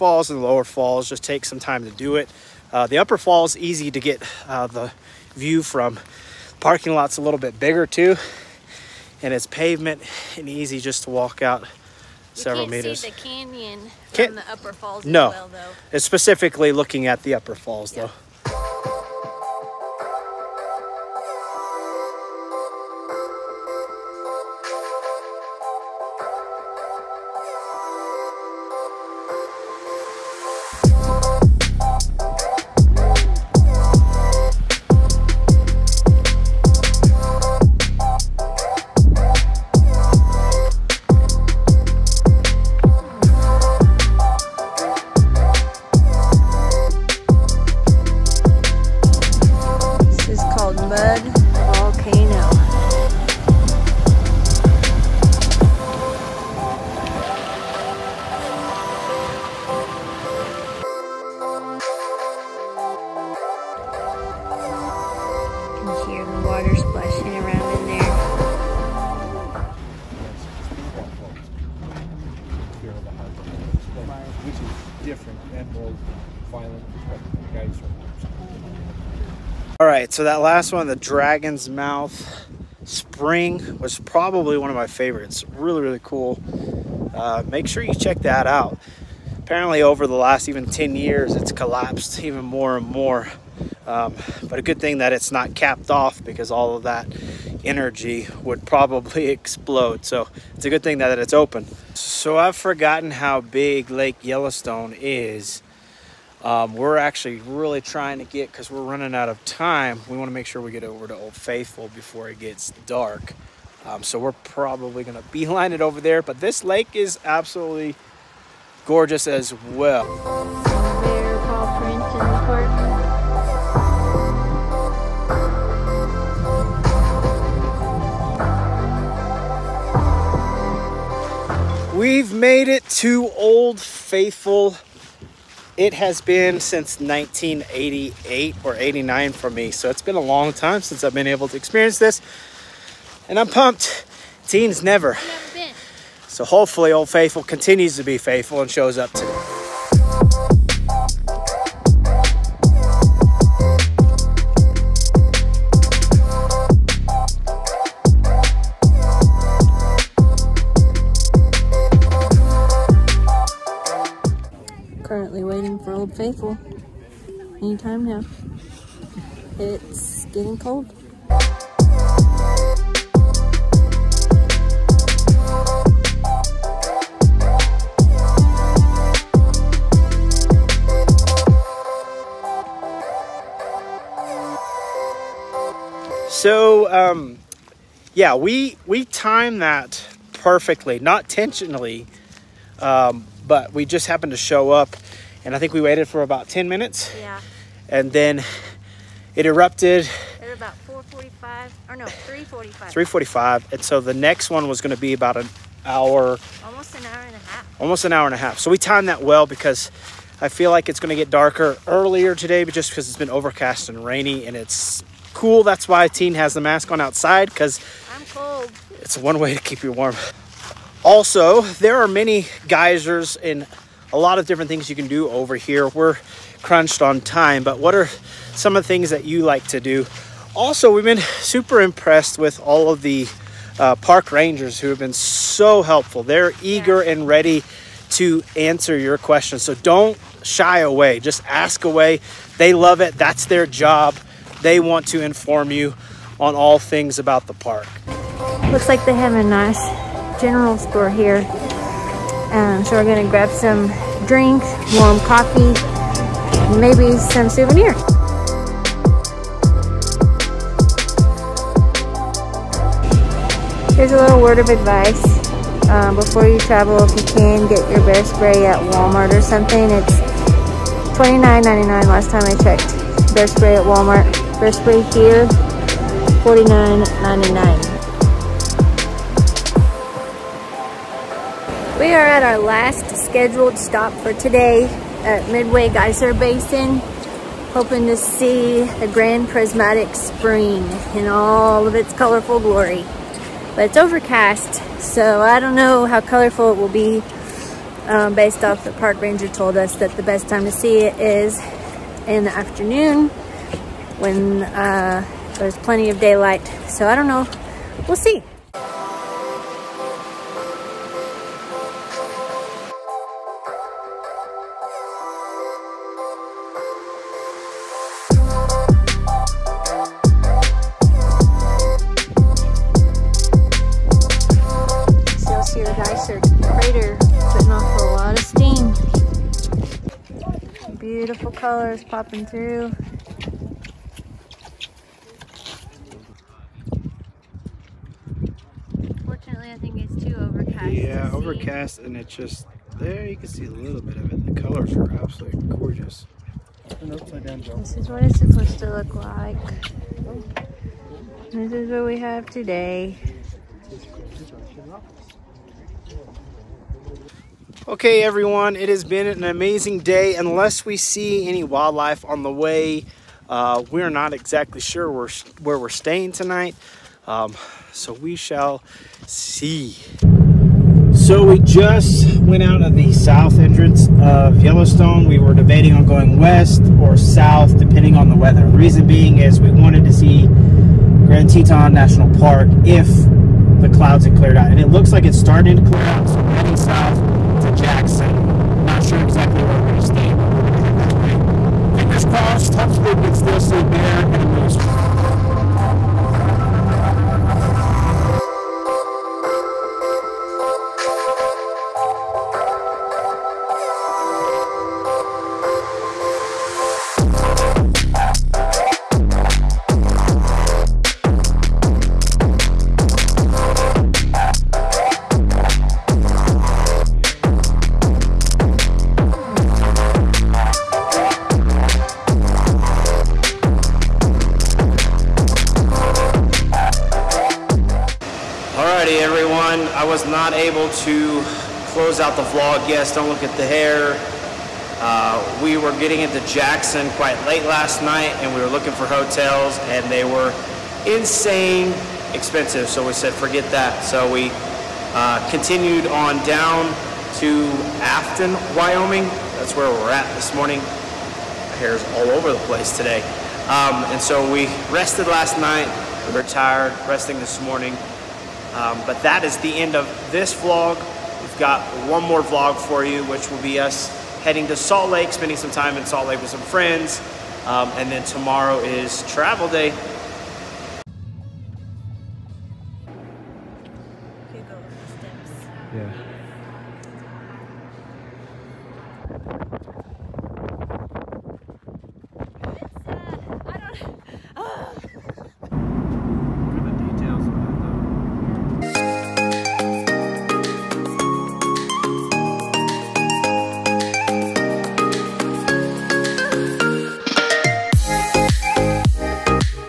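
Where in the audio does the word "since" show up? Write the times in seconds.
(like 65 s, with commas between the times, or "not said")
136 s, 140 s.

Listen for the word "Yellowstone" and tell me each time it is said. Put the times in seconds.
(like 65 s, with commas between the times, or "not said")
104 s, 374 s.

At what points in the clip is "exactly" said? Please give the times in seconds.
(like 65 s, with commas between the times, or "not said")
364 s, 389 s.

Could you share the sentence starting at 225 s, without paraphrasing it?
We're crunched on time, but what are some of the things that you like to do?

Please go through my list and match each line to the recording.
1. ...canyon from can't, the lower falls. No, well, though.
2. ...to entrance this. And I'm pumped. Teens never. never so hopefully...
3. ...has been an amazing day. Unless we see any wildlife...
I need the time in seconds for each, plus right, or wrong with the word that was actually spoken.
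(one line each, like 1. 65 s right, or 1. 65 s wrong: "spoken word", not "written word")
1. 13 s wrong: "upper", not "lower"
2. 141 s wrong: "experience", not "entrance"
3. 358 s right.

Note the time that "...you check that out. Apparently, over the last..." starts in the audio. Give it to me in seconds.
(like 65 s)
87 s.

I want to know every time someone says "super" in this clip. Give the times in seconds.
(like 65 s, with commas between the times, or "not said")
231 s.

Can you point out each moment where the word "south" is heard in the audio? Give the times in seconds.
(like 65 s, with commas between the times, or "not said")
373 s, 377 s, 386 s.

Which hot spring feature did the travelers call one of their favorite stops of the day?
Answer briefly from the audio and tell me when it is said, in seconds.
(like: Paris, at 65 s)
Dragon's Mouth Spring, at 80 s.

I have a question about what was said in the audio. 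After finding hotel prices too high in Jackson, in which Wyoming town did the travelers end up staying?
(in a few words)
Afton.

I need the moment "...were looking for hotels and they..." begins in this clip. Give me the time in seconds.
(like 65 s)
438 s.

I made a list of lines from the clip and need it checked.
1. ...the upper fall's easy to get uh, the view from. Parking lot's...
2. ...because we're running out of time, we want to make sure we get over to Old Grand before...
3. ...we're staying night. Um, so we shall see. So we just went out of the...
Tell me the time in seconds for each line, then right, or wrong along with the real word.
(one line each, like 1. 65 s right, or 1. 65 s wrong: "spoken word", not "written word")
1. 2 s right
2. 108 s wrong: "Faithful", not "Grand"
3. 365 s wrong: "tonight", not "night".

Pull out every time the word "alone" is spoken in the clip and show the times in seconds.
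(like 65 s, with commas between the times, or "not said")
not said.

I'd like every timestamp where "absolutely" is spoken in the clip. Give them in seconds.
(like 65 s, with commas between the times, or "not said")
117 s, 345 s.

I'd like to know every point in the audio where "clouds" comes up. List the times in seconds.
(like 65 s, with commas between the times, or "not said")
383 s.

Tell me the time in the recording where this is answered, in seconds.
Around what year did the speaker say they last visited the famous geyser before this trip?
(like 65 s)
136 s.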